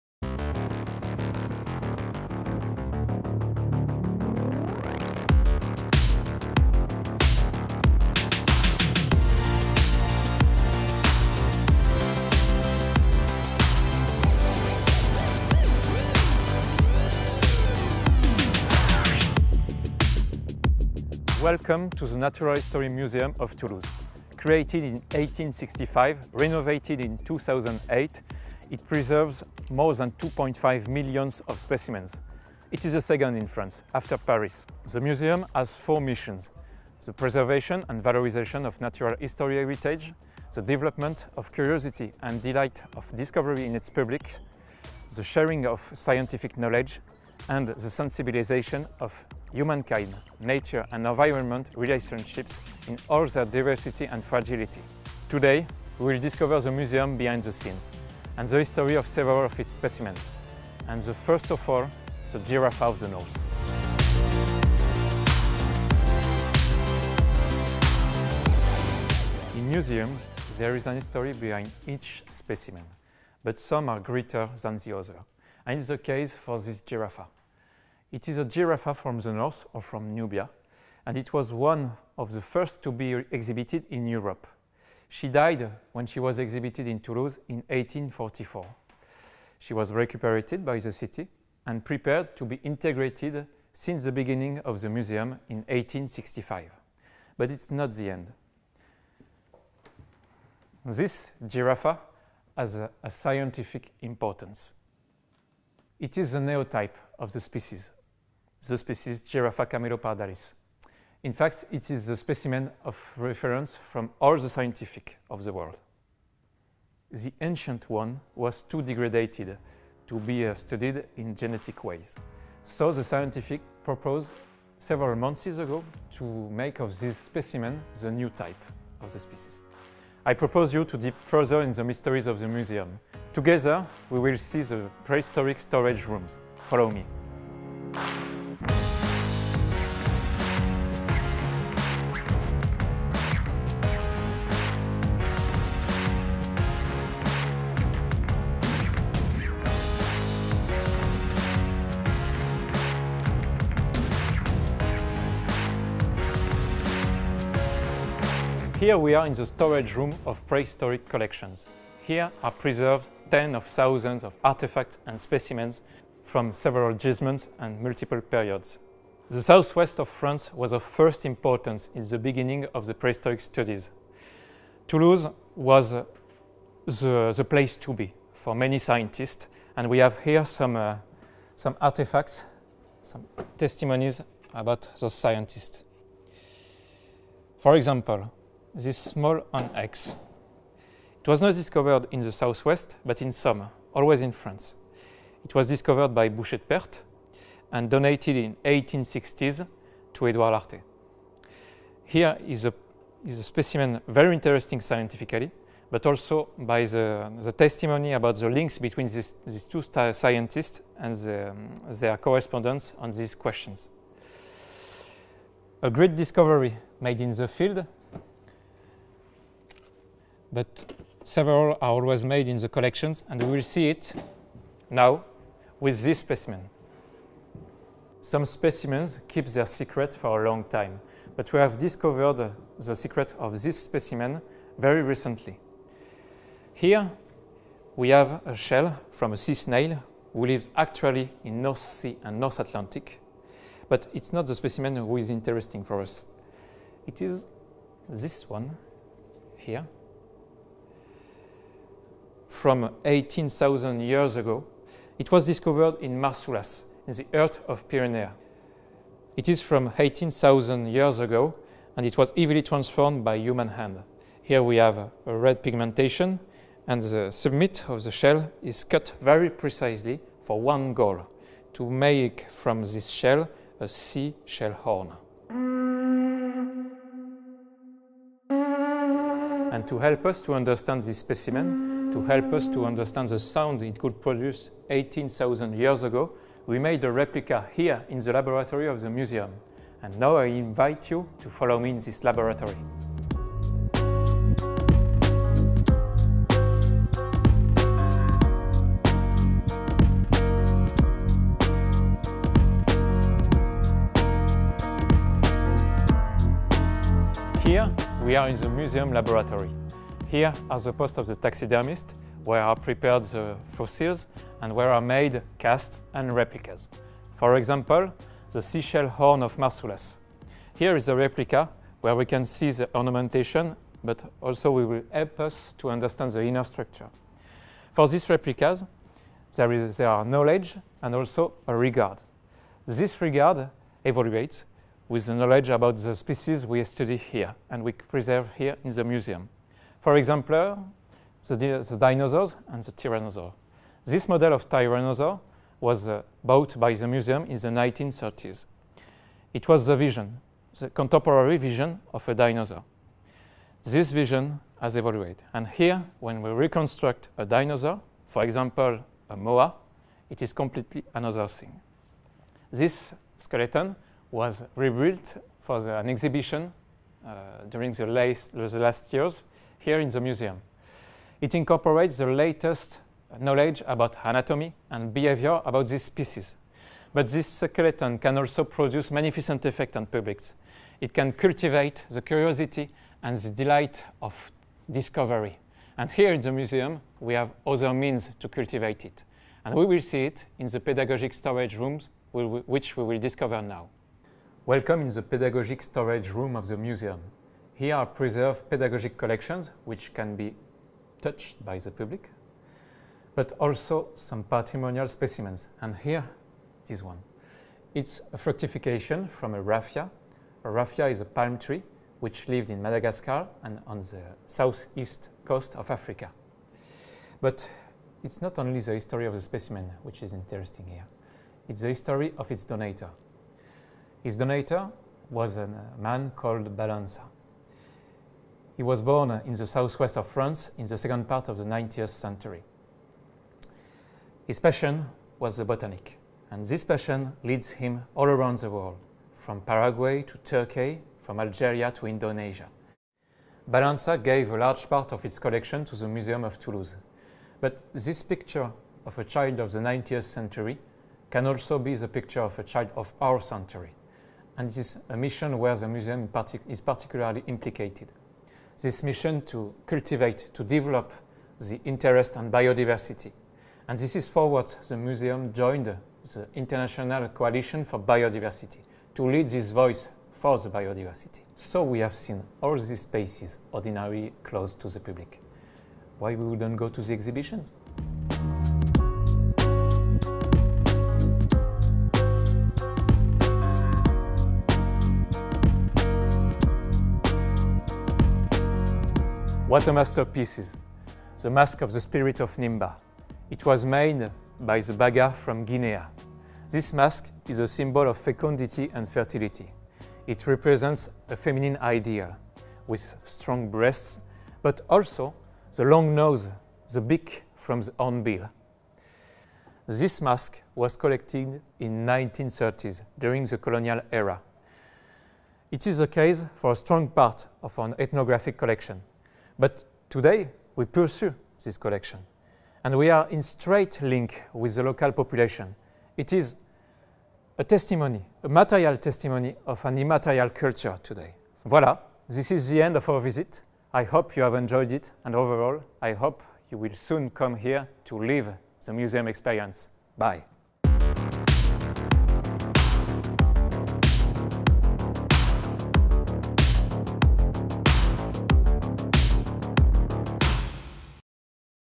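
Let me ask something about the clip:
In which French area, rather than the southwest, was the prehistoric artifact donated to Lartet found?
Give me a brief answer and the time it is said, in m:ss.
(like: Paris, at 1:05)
Somme, at 3:13.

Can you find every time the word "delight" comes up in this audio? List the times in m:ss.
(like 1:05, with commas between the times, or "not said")
0:42, 6:23.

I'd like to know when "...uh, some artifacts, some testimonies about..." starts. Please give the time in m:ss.
3:00.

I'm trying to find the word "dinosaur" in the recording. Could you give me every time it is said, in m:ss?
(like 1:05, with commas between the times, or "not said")
5:41, 5:52, 5:57.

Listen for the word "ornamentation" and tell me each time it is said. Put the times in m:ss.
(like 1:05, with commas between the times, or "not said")
5:22.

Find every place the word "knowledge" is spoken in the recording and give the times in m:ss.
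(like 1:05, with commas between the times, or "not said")
0:46, 5:30, 5:35, 6:13.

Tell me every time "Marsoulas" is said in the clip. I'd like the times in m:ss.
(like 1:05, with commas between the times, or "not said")
4:16, 5:19.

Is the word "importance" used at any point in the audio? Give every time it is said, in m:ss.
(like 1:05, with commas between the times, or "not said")
1:44, 2:51.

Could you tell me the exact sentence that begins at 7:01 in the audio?
It's the history of its donator.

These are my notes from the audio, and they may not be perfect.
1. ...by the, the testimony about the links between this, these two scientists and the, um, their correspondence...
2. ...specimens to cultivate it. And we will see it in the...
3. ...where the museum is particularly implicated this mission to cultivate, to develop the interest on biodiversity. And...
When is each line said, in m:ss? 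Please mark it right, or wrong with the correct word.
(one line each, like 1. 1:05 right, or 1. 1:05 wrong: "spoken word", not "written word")
1. 3:26 right
2. 6:27 wrong: "means", not "specimens"
3. 7:35 right.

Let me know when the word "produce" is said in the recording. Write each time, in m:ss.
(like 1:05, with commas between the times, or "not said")
4:44, 6:18.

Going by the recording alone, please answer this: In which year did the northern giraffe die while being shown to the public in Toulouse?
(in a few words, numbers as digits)
1844.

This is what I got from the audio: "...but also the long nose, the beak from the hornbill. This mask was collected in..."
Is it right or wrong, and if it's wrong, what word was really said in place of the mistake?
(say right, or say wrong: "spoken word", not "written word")
right.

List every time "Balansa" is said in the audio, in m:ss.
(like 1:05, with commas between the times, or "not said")
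7:06, 7:23.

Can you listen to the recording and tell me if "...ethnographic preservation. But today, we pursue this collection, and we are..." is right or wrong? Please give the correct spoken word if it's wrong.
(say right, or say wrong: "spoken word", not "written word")
wrong: "collection", not "preservation".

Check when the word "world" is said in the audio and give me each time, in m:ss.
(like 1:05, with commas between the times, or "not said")
1:55, 7:18.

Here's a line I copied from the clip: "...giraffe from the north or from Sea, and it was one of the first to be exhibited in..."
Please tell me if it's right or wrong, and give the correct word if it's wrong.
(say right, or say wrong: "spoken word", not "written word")
wrong: "Nubia", not "Sea".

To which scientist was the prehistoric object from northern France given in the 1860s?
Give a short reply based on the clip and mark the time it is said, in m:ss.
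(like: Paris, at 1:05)
Edouard Lartet, at 3:20.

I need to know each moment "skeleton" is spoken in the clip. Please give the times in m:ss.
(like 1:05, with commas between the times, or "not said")
6:03, 6:17.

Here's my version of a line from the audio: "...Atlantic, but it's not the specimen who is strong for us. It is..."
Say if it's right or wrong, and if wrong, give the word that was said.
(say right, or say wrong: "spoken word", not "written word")
wrong: "interesting", not "strong".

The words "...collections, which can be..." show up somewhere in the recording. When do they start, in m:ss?
6:39.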